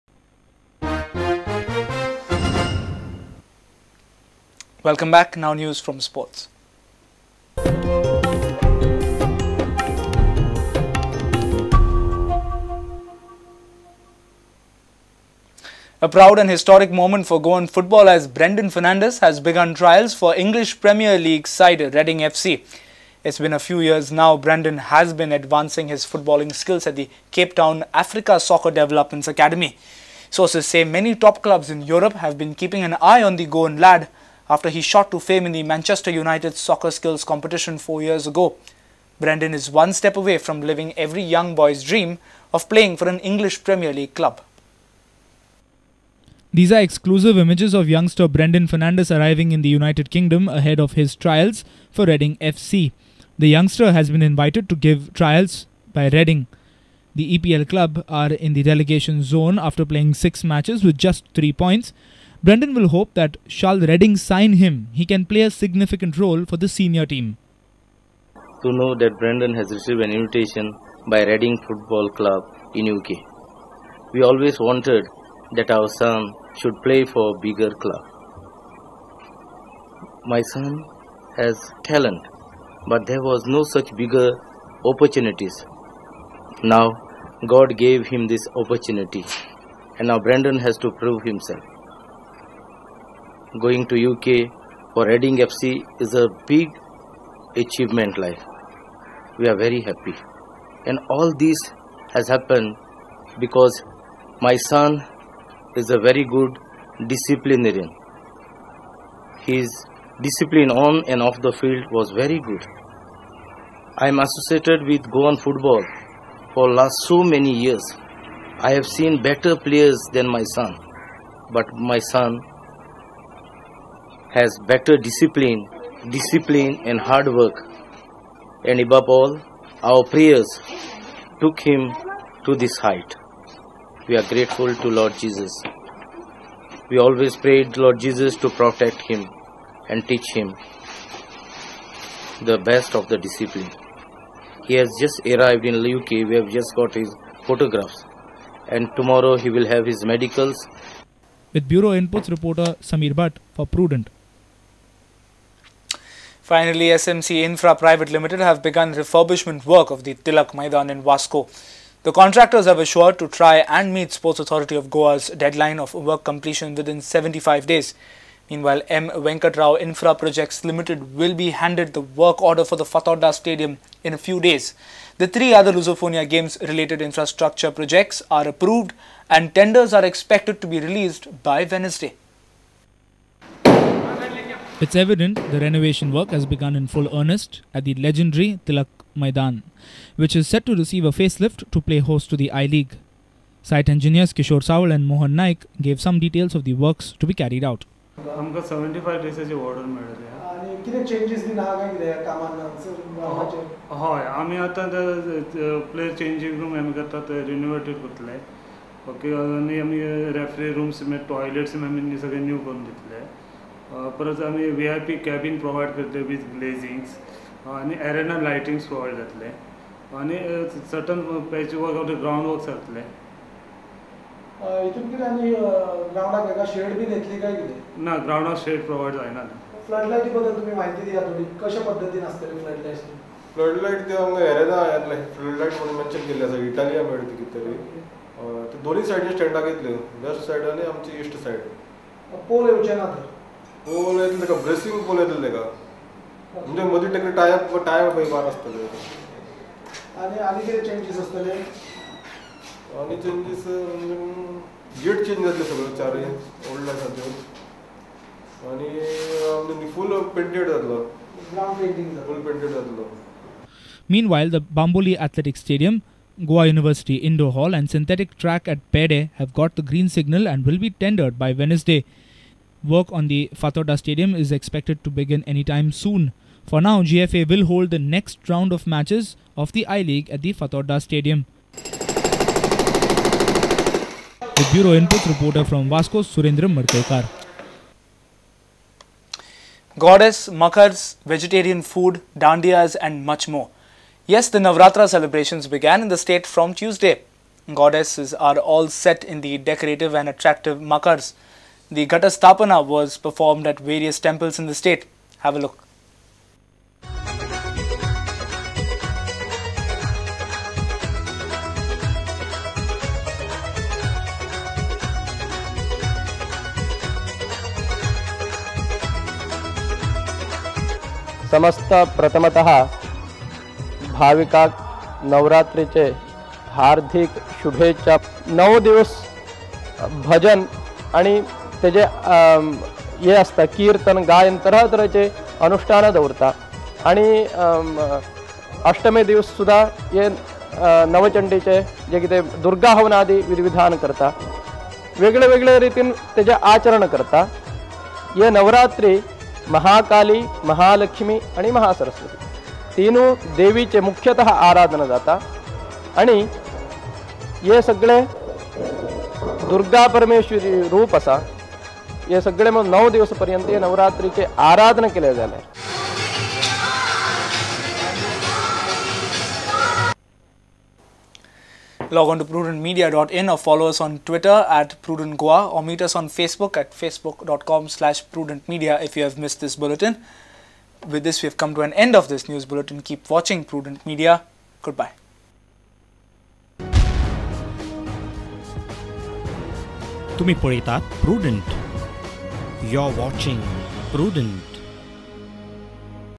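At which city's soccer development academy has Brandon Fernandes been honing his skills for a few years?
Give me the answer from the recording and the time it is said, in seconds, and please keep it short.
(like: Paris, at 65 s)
Cape Town, at 27 s.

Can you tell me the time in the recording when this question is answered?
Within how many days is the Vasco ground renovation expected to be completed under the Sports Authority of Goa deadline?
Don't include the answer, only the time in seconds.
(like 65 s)
166 s.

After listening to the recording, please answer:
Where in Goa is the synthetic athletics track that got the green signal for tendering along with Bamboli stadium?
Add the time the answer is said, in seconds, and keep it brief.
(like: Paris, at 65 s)
Pede, at 268 s.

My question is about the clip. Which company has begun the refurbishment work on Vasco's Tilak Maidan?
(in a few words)
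SMC Infra Private Limited.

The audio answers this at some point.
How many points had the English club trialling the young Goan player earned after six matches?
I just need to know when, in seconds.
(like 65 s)
61 s.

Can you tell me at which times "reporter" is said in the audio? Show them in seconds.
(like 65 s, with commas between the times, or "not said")
152 s, 285 s.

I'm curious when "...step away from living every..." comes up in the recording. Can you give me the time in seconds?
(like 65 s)
39 s.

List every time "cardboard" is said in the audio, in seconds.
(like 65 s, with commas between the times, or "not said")
not said.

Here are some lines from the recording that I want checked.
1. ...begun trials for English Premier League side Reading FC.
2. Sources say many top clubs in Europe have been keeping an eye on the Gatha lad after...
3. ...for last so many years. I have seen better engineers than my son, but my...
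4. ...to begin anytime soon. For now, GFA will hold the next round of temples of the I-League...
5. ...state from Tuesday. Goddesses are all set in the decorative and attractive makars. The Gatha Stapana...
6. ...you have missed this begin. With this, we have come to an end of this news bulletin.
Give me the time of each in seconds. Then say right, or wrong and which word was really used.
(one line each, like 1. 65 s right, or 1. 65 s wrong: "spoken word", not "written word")
1. 19 s right
2. 30 s wrong: "Goan", not "Gatha"
3. 116 s wrong: "players", not "engineers"
4. 275 s wrong: "matches", not "temples"
5. 296 s right
6. 379 s wrong: "bulletin", not "begin".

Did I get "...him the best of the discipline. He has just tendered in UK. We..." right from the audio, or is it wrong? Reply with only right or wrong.
wrong.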